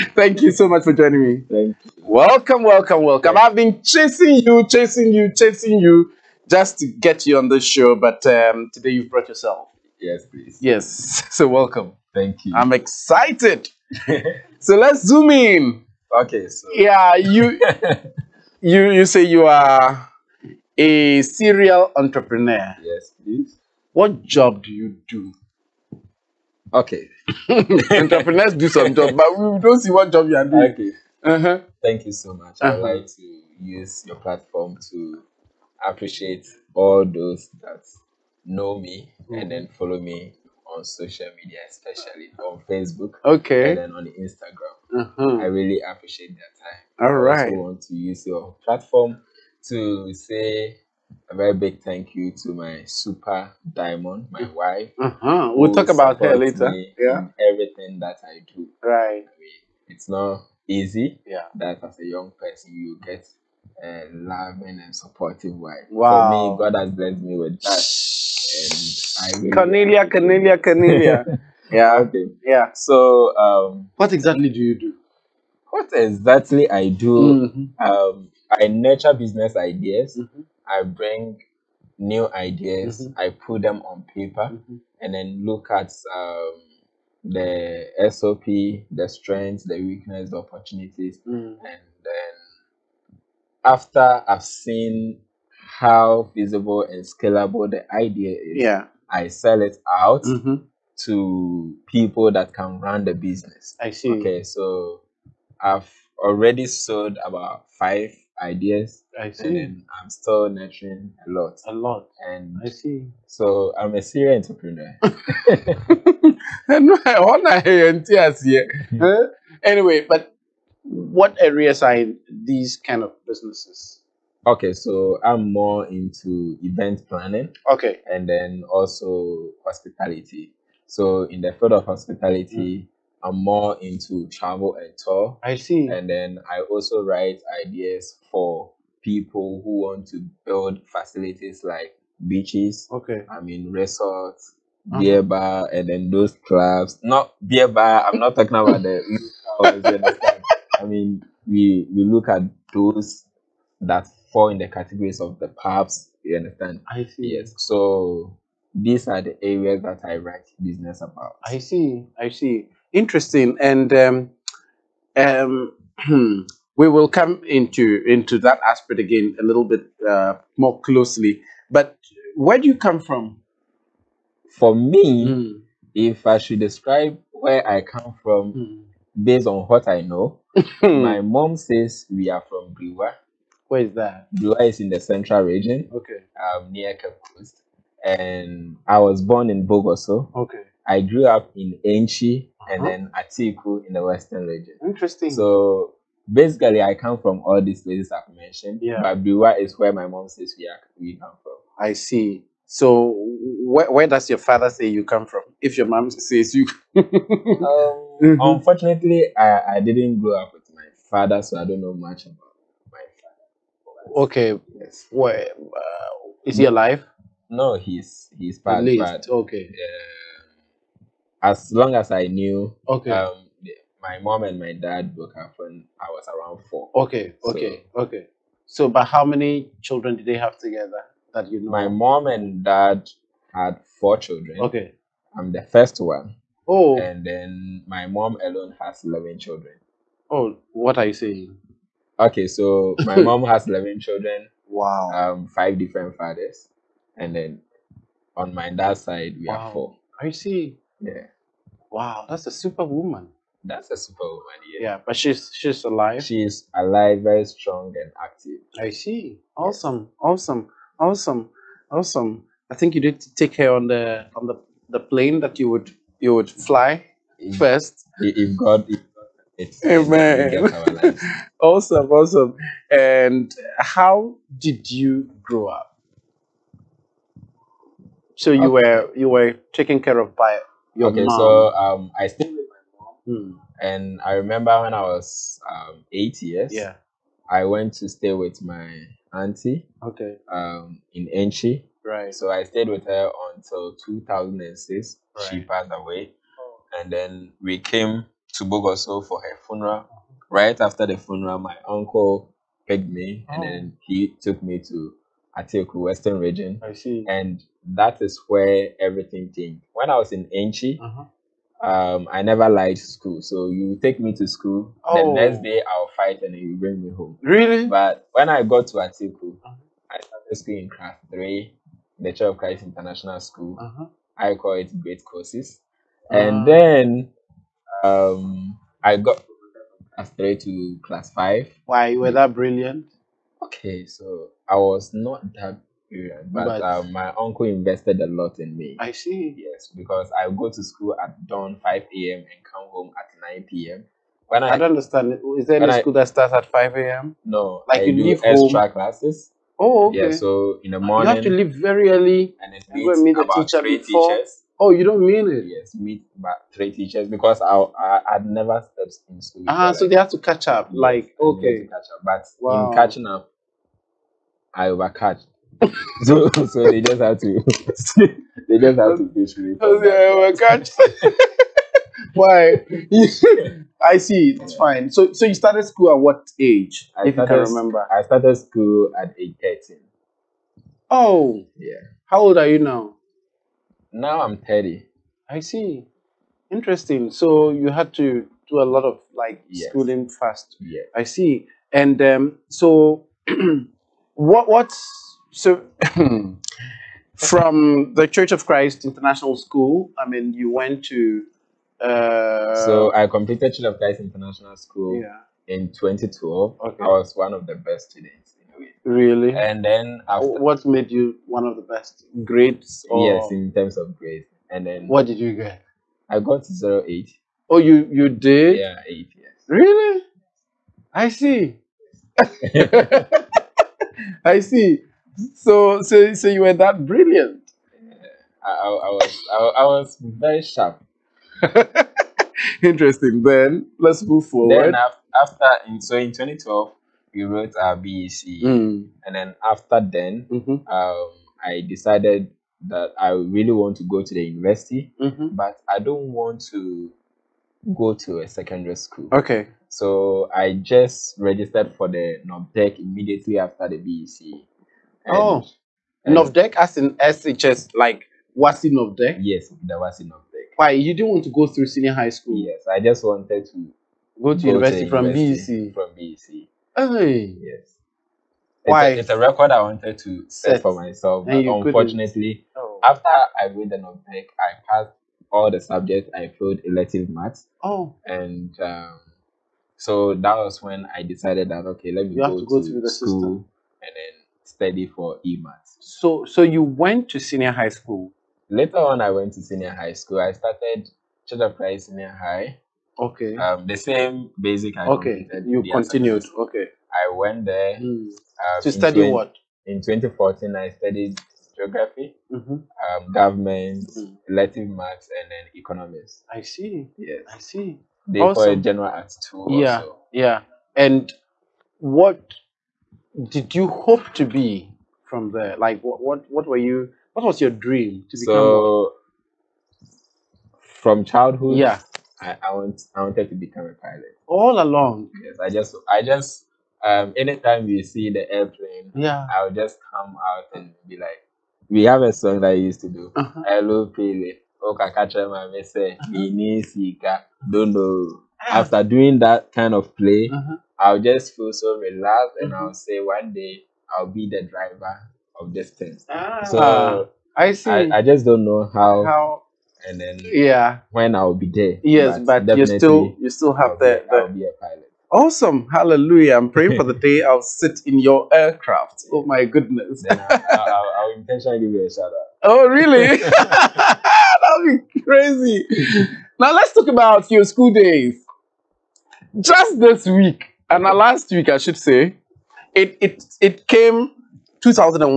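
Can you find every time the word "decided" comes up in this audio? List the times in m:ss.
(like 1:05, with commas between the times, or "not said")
7:21, 8:01.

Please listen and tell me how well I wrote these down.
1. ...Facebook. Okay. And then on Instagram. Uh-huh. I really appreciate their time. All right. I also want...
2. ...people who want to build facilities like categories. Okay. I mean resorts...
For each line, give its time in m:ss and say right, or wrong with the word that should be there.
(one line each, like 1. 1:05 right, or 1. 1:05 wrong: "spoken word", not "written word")
1. 0:42 right
2. 2:19 wrong: "beaches", not "categories".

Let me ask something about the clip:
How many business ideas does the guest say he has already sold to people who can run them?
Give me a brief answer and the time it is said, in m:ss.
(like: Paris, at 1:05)
5, at 1:47.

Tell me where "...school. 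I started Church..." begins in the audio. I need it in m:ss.
8:10.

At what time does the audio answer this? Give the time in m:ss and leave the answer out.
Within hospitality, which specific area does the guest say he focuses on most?
2:14.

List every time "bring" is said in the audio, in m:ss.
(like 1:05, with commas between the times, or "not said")
1:20, 5:16.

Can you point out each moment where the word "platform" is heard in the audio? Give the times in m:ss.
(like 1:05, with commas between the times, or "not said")
0:34, 0:48.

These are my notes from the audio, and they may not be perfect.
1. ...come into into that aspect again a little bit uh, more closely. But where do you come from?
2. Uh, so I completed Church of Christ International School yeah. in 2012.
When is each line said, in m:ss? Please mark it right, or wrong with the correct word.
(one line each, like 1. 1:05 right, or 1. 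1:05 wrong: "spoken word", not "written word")
1. 2:47 right
2. 6:41 right.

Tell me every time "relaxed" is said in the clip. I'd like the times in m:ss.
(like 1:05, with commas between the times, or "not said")
9:01.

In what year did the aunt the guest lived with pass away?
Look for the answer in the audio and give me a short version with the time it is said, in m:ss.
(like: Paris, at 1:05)
2006, at 4:53.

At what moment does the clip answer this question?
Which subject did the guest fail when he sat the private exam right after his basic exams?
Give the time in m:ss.
7:56.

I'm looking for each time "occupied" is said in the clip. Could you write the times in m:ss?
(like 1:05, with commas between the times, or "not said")
not said.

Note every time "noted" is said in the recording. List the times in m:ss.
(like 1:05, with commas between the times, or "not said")
not said.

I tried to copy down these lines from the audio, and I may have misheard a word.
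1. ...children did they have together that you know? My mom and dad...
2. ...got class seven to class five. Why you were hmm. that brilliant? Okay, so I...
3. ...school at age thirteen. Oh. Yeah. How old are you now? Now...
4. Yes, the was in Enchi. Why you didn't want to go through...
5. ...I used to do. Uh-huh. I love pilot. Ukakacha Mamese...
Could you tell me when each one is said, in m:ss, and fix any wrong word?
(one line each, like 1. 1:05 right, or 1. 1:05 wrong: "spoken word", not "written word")
1. 3:49 right
2. 5:29 wrong: "three", not "seven"
3. 6:18 right
4. 7:39 wrong: "NOVDEC", not "Enchi"
5. 8:52 right.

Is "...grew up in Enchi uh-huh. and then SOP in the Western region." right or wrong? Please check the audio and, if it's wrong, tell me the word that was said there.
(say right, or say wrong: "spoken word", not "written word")
wrong: "Atiku", not "SOP".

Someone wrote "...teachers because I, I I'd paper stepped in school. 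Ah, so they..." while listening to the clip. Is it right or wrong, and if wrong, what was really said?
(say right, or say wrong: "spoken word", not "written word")
wrong: "never", not "paper".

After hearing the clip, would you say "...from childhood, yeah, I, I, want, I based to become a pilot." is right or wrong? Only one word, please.
wrong.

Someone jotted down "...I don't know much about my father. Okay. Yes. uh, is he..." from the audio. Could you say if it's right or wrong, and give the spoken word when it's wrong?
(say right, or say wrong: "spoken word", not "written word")
right.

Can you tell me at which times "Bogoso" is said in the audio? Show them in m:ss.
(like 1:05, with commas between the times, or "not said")
3:09, 4:58.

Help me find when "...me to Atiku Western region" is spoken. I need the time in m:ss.
5:04.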